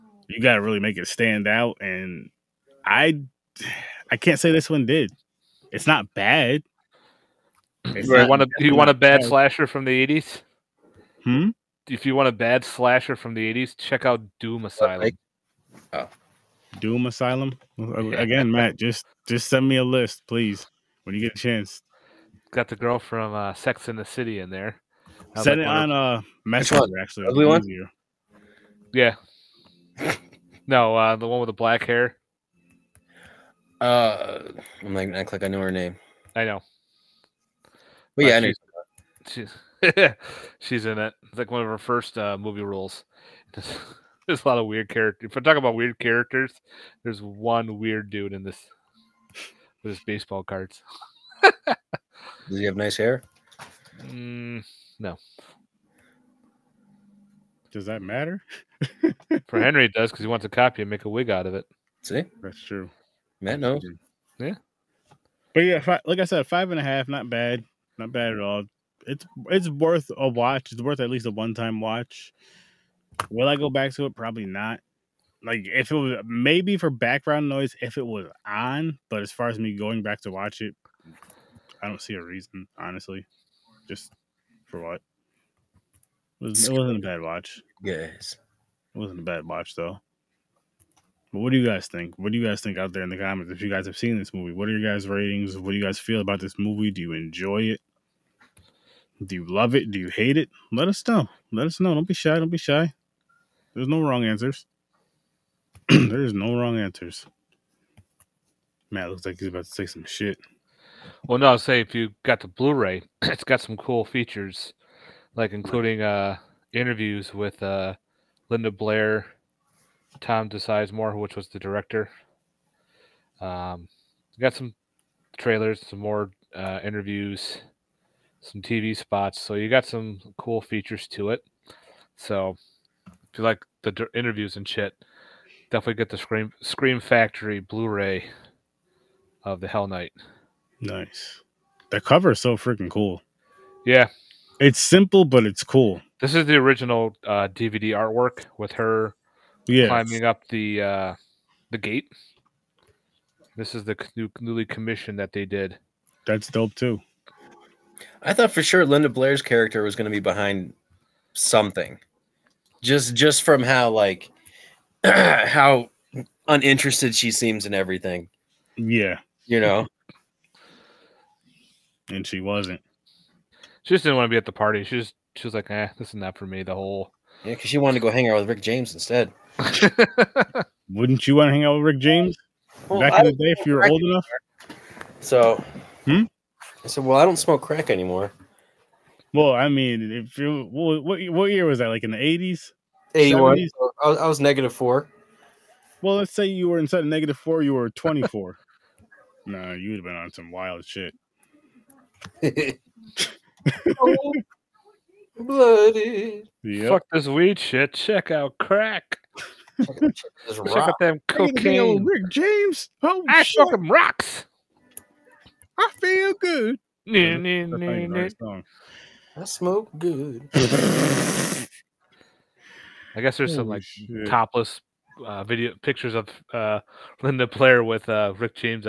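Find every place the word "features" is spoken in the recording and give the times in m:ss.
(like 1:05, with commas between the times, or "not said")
1:54, 2:10.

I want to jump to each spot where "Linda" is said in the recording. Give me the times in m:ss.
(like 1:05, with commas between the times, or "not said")
1:58, 2:38, 3:47.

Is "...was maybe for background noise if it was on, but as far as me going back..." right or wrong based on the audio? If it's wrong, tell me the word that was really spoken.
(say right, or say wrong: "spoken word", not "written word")
right.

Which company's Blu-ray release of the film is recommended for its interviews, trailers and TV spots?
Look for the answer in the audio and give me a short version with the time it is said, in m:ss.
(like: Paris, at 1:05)
Scream Factory, at 2:16.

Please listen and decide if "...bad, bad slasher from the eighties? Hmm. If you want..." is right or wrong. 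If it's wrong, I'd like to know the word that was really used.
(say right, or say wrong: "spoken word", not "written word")
right.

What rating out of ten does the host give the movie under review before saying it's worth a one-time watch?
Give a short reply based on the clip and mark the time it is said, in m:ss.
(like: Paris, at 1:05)
5.5, at 1:06.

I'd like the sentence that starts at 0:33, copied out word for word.
Uh, I'm like, I to act like I know her name.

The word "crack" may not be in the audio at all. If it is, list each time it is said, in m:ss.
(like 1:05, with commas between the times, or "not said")
3:07, 3:28.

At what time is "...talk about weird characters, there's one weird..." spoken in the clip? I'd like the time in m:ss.
0:45.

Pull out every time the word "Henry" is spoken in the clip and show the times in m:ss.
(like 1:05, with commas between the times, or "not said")
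0:59.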